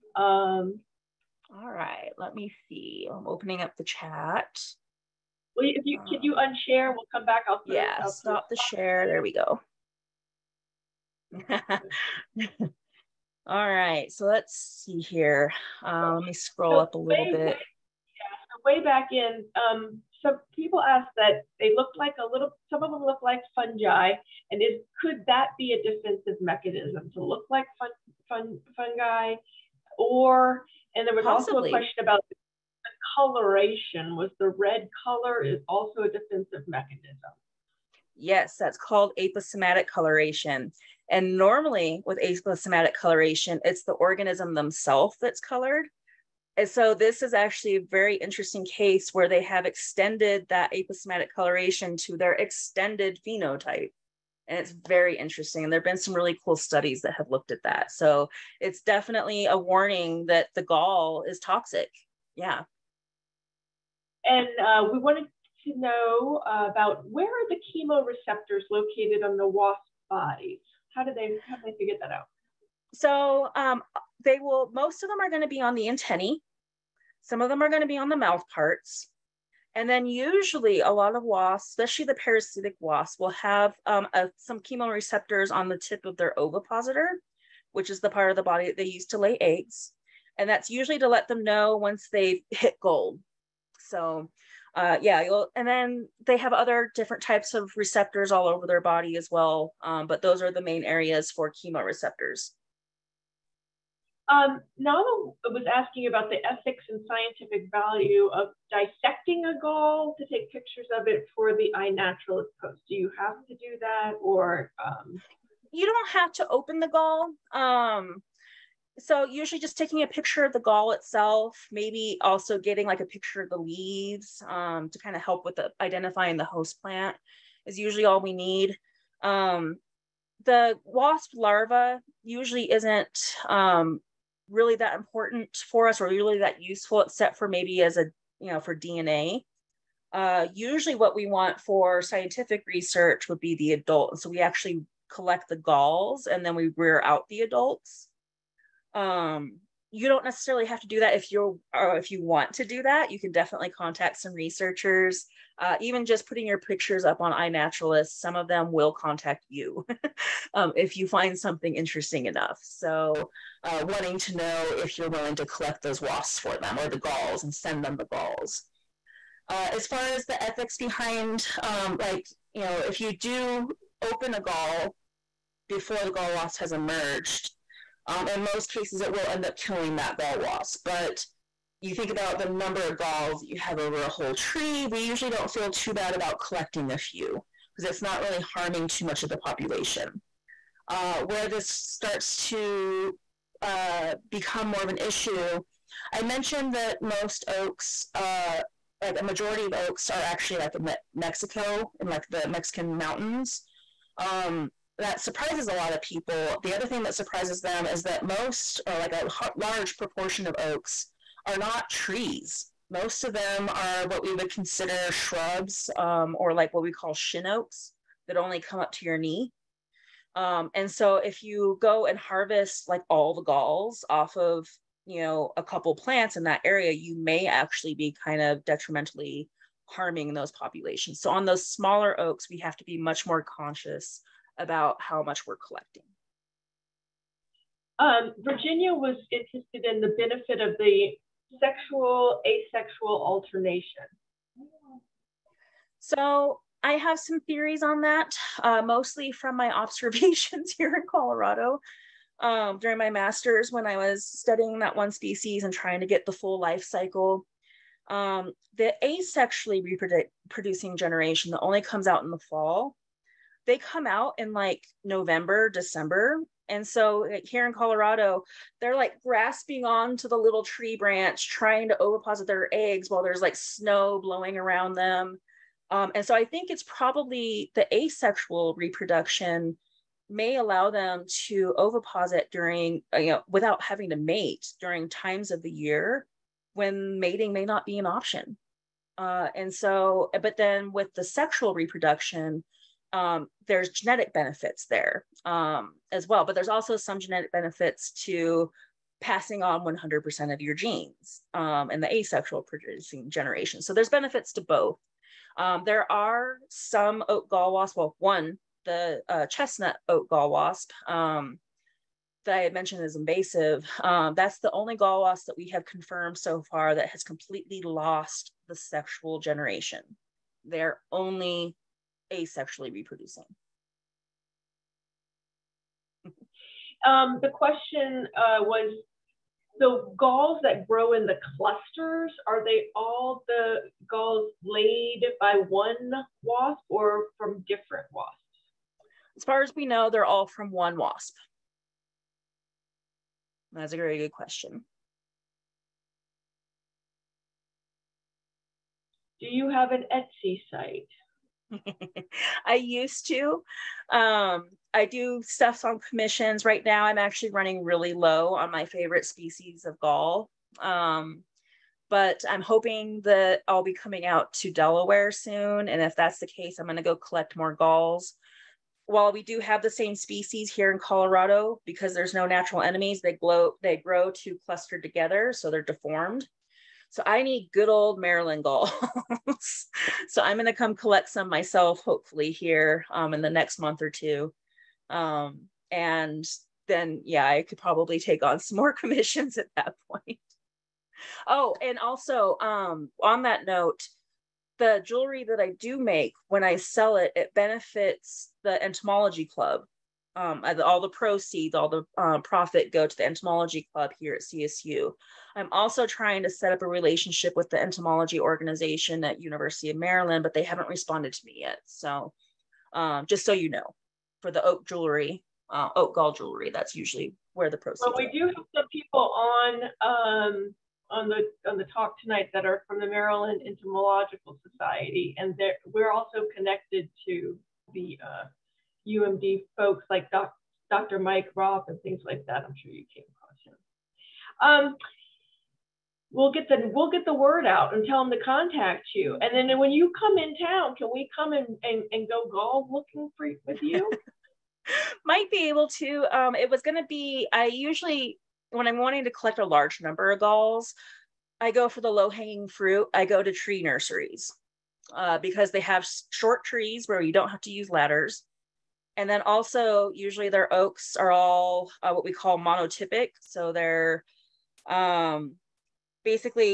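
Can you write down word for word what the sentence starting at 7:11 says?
Mike Raupp and things like that.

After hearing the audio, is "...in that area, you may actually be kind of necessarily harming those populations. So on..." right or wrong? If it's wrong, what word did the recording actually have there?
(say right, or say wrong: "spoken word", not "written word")
wrong: "detrimentally", not "necessarily".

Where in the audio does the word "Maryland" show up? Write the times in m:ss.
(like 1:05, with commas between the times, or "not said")
6:18, 6:49, 7:03.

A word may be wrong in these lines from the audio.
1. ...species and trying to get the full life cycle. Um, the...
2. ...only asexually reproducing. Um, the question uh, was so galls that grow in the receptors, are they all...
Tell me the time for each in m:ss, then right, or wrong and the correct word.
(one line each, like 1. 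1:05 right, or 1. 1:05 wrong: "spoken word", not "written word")
1. 4:15 right
2. 5:21 wrong: "clusters", not "receptors".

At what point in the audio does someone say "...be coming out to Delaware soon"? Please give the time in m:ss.
6:03.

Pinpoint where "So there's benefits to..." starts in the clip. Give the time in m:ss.
5:03.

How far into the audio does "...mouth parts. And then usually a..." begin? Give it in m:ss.
1:18.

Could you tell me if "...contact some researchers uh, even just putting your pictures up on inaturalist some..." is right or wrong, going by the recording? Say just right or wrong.
right.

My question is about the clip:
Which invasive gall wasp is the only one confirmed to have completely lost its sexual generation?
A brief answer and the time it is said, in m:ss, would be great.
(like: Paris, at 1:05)
chestnut oak gall wasp, at 5:09.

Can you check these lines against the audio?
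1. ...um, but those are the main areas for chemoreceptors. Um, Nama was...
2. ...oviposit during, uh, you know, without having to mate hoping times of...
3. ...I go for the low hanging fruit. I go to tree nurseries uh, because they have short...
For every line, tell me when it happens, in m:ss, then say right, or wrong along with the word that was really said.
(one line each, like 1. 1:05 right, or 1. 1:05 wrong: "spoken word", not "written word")
1. 1:39 right
2. 4:41 wrong: "during", not "hoping"
3. 7:31 right.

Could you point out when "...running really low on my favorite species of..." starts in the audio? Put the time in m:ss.
5:57.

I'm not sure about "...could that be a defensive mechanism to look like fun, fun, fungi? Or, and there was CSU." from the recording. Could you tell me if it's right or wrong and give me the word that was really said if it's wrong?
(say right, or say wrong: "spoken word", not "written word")
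wrong: "Possibly", not "CSU".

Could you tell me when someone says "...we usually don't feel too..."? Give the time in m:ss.
3:04.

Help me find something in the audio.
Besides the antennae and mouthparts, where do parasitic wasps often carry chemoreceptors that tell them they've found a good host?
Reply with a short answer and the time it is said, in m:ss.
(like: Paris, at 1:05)
tip of their ovipositor, at 1:25.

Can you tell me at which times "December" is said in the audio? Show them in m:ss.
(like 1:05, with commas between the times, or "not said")
4:25.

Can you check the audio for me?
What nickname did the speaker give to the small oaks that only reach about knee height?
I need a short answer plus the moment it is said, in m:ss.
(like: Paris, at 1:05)
shin oaks, at 3:37.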